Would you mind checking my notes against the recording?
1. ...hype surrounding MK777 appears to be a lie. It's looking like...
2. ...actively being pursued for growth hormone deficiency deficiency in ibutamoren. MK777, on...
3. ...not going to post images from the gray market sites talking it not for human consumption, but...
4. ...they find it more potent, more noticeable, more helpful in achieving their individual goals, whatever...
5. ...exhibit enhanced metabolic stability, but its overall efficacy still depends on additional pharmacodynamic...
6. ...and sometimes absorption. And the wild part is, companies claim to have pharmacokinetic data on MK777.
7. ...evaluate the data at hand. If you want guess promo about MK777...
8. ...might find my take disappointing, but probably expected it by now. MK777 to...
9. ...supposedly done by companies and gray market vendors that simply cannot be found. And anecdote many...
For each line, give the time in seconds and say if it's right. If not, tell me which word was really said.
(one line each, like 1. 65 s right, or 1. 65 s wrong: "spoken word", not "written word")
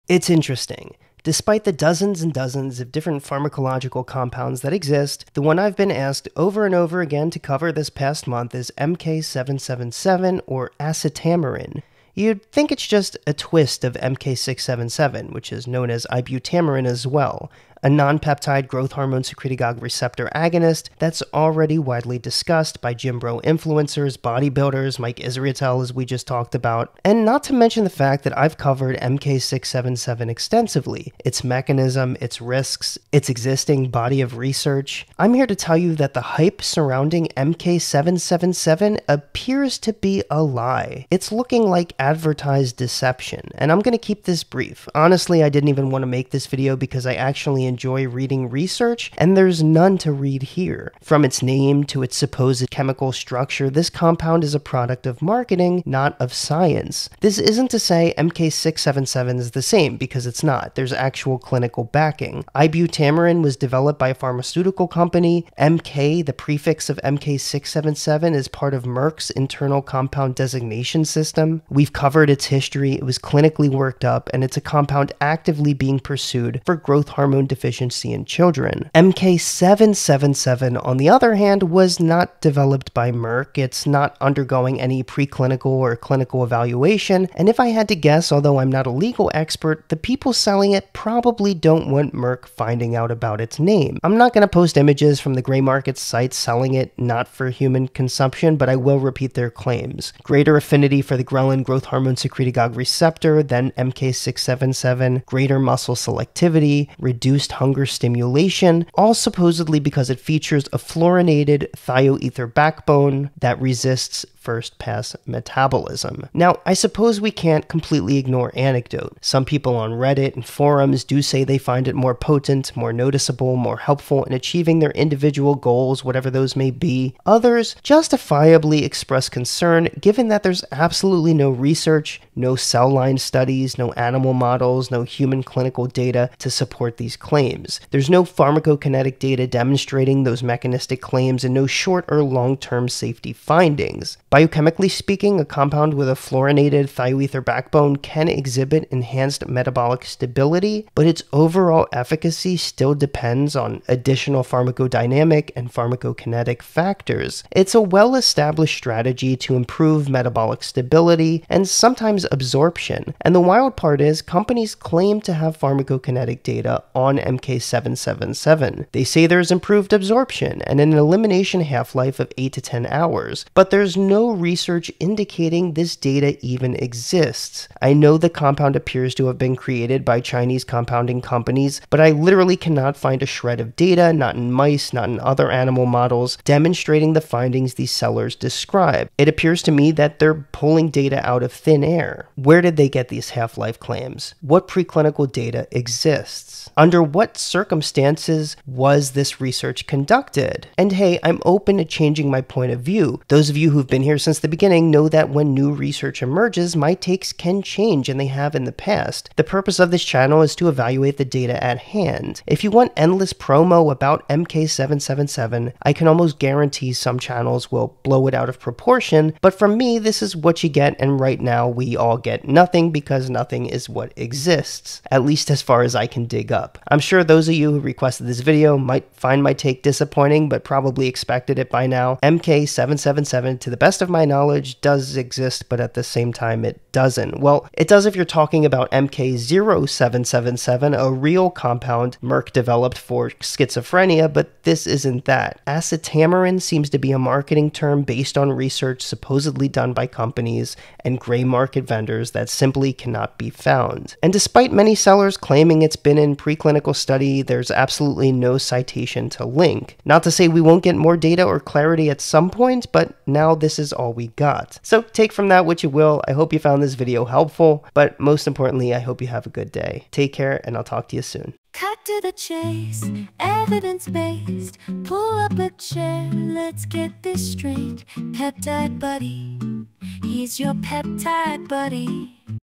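1. 36 s right
2. 75 s wrong: "children", not "ibutamoren"
3. 94 s wrong: "selling", not "talking"
4. 121 s right
5. 148 s right
6. 161 s right
7. 210 s wrong: "endless", not "guess"
8. 228 s right
9. 249 s wrong: "despite", not "anecdote".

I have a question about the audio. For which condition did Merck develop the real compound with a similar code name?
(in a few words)
schizophrenia.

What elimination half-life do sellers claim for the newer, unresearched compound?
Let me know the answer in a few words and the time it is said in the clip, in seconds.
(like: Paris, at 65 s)
8 to 10 hours, at 172 s.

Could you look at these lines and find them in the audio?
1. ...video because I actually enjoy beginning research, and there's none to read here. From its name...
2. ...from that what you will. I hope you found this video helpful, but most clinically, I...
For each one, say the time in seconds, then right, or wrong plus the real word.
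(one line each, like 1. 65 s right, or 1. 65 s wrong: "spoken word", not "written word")
1. 46 s wrong: "reading", not "beginning"
2. 265 s wrong: "importantly", not "clinically".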